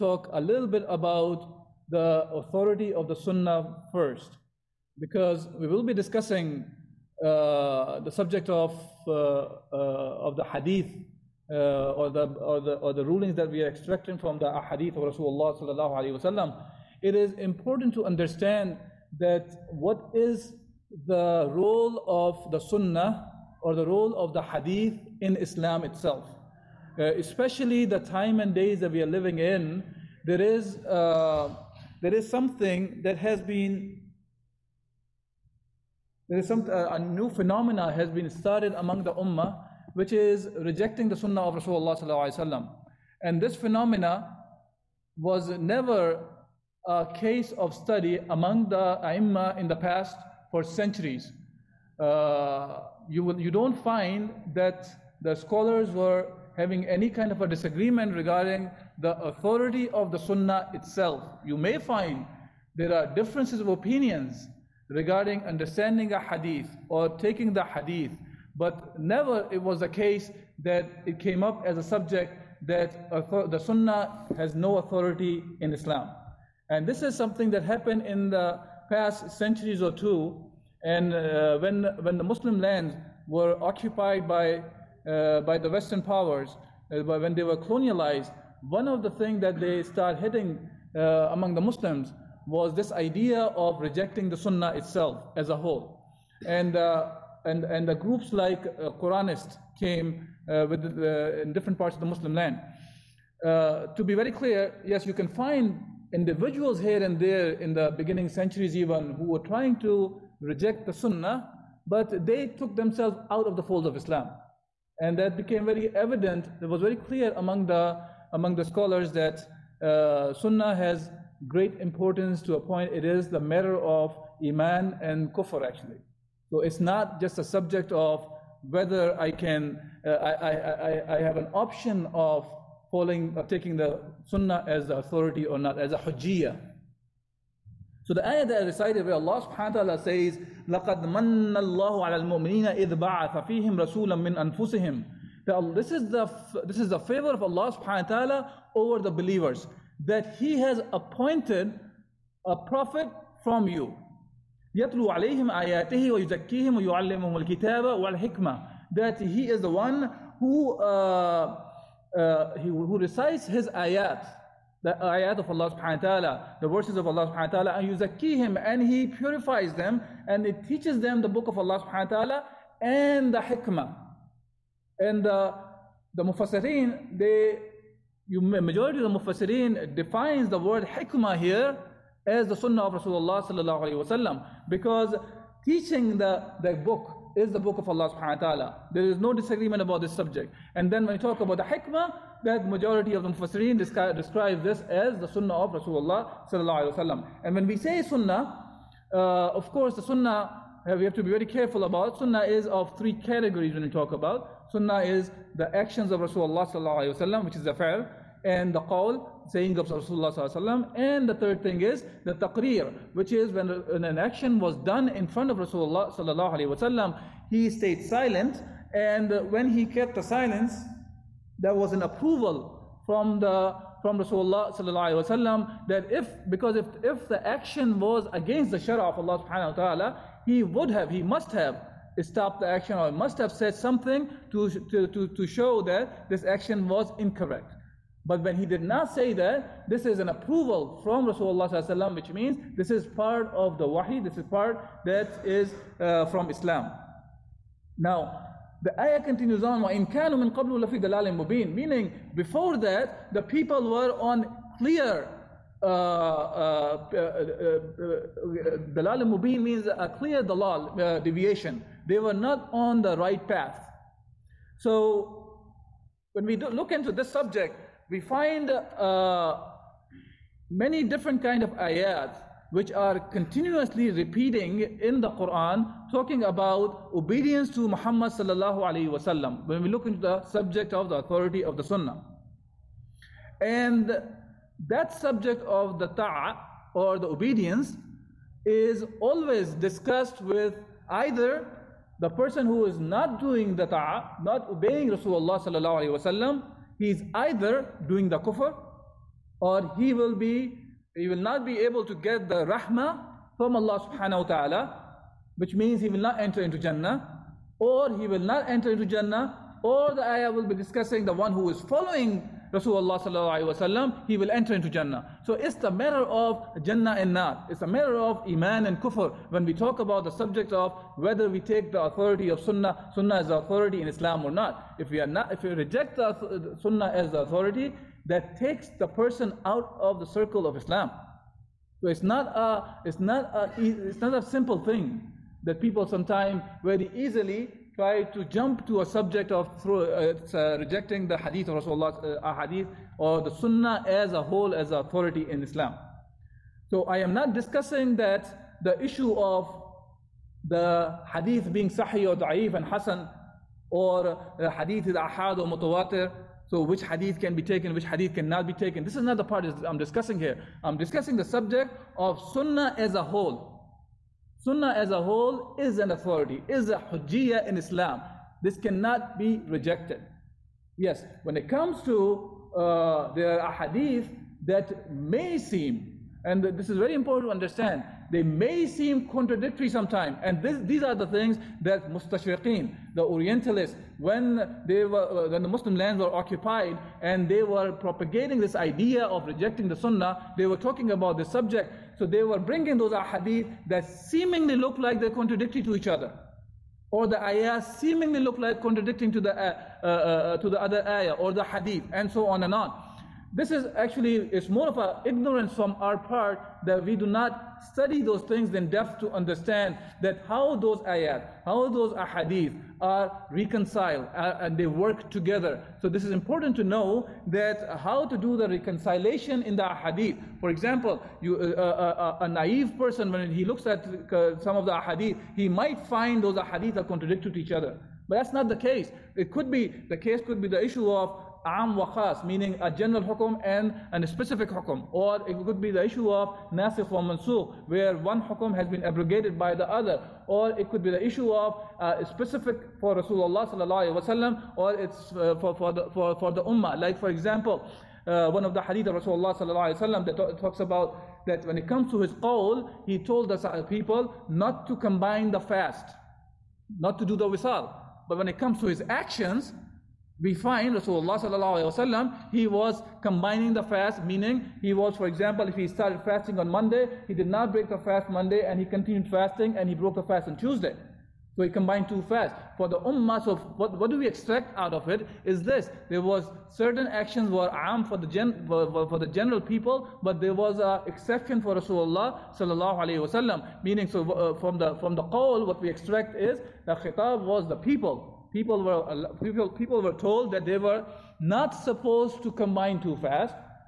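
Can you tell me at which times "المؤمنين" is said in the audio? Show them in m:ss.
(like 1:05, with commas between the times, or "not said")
2:22.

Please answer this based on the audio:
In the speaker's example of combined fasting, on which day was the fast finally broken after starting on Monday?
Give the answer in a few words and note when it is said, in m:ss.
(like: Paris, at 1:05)
Tuesday, at 7:50.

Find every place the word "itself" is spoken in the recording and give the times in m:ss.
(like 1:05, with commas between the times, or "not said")
0:25, 1:00, 1:34.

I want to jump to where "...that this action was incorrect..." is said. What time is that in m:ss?
3:55.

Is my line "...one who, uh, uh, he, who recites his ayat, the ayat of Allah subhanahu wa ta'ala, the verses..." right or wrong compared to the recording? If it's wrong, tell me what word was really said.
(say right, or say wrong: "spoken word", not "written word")
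right.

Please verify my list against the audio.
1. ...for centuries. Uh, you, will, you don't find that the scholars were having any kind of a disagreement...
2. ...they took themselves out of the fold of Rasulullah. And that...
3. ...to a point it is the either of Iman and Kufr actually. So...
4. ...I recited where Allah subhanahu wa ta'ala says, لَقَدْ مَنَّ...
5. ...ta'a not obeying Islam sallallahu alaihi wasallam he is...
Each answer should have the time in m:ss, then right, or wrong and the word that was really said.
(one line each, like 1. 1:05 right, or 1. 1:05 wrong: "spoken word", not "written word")
1. 0:50 right
2. 1:52 wrong: "Islam", not "Rasulullah"
3. 2:02 wrong: "matter", not "either"
4. 2:18 right
5. 4:53 wrong: "Rasulullah", not "Islam".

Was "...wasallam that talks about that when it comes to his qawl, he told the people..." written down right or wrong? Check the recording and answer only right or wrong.
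right.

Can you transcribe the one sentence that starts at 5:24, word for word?
If we are not, if we reject the Sunnah as the authority, that takes the person out of the circle of Islam.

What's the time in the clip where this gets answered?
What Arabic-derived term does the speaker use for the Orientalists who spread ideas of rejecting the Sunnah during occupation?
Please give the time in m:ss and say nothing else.
6:22.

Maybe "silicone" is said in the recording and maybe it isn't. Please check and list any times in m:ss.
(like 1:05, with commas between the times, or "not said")
not said.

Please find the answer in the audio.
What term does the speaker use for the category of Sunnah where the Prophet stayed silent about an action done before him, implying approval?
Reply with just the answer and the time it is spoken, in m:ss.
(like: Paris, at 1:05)
taqreer, at 3:32.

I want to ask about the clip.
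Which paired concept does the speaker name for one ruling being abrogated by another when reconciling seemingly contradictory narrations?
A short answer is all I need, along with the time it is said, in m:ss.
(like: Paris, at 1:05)
nasikh wa mansukh, at 7:16.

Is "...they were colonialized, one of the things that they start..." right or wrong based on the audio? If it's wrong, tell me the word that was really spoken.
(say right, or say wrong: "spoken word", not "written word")
right.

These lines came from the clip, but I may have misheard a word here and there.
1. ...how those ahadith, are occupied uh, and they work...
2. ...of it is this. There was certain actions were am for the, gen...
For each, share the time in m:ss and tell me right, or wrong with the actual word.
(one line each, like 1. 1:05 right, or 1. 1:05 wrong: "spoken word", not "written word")
1. 6:51 wrong: "reconciled", not "occupied"
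2. 7:54 right.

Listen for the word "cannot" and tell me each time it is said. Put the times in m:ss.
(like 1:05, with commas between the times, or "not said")
5:58, 6:08.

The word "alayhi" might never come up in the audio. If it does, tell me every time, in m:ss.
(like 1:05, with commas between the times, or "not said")
3:16, 8:03.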